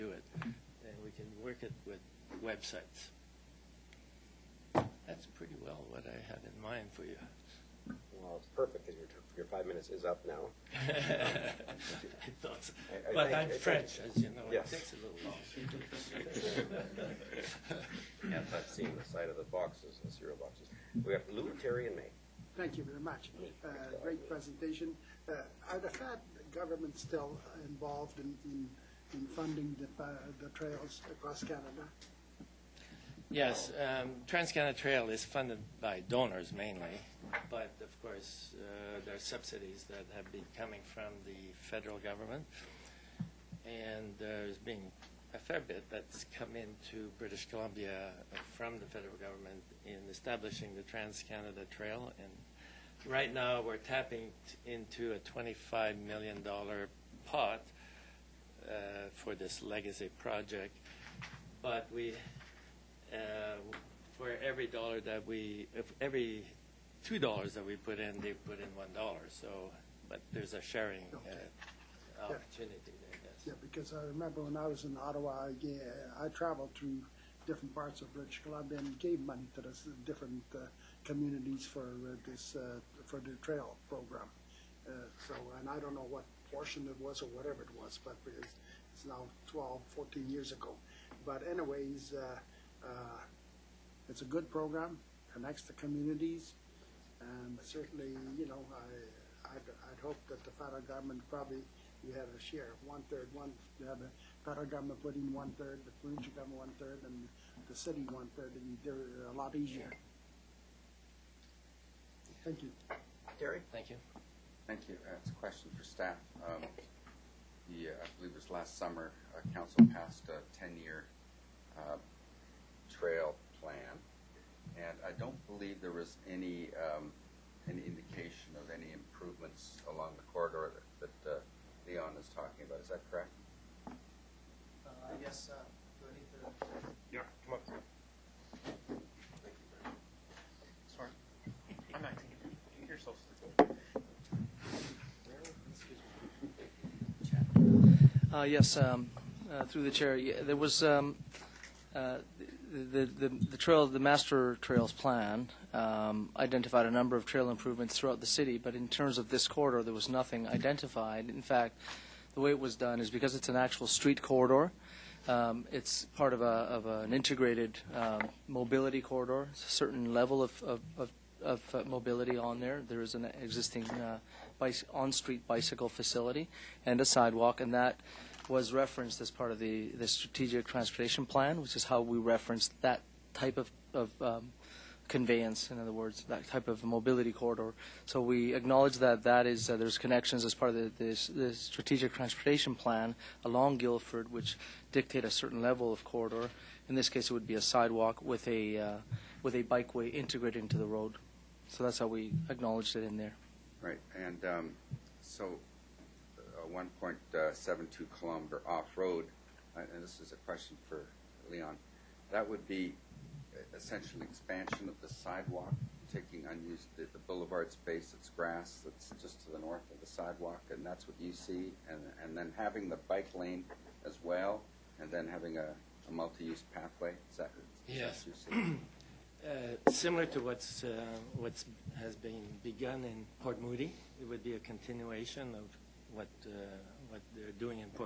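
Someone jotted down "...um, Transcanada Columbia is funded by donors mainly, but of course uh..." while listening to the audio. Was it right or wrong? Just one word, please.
wrong.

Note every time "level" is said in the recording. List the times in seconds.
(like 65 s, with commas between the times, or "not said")
170 s, 195 s.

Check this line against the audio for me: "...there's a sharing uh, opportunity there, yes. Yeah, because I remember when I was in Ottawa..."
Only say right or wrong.
right.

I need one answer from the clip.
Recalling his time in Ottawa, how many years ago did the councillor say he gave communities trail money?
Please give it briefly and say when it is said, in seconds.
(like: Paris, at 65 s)
12, 14 years, at 89 s.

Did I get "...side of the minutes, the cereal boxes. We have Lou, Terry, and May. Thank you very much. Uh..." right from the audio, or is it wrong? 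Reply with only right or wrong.
wrong.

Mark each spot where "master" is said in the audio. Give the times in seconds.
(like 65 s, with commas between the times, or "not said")
153 s.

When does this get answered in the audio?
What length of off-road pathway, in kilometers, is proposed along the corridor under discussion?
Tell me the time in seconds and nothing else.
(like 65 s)
206 s.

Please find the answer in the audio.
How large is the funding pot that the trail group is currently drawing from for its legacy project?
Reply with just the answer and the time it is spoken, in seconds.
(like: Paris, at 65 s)
$25 million, at 55 s.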